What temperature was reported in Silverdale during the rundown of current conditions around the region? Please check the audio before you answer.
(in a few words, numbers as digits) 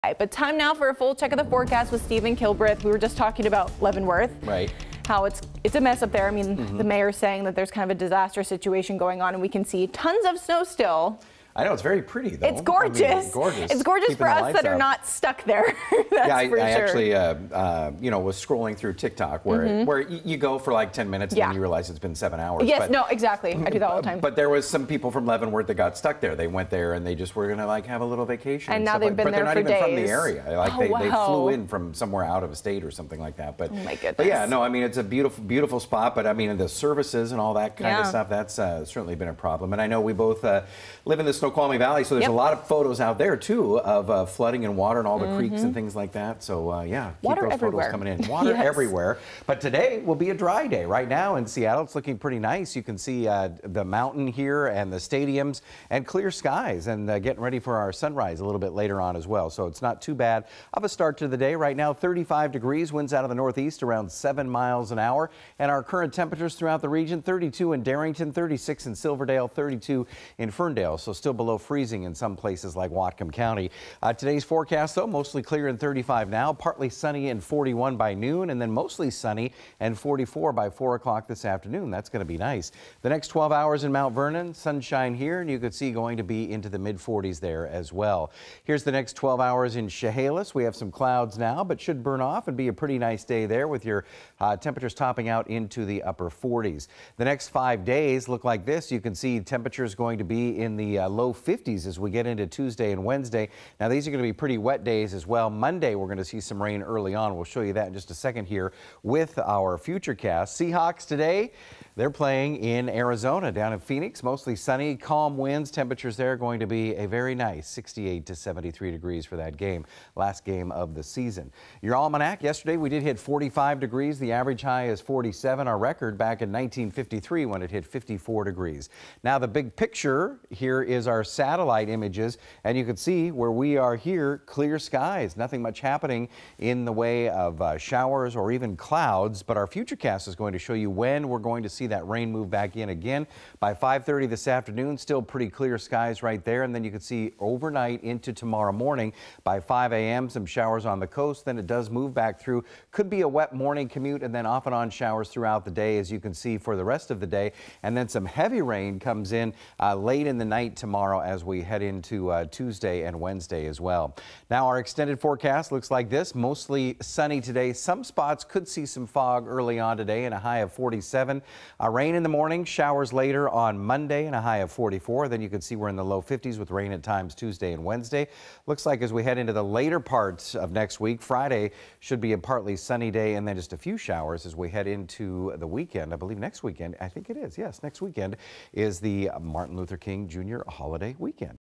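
36.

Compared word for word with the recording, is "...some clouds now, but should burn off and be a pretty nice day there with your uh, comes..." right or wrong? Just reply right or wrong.
wrong.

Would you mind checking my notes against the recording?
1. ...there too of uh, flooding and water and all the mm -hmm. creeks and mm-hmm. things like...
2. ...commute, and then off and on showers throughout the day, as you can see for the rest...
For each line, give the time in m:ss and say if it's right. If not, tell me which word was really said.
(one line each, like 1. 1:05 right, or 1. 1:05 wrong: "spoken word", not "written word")
1. 0:43 right
2. 2:33 right.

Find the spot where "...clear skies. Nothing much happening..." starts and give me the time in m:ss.
2:14.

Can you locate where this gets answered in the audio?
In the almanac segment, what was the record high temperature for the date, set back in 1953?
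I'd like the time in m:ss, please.
2:07.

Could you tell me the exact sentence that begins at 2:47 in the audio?
Some spots could see some fog early on today and a high of 47.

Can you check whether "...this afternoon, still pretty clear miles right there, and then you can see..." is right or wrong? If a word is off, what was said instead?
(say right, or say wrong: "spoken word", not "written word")
wrong: "skies", not "miles".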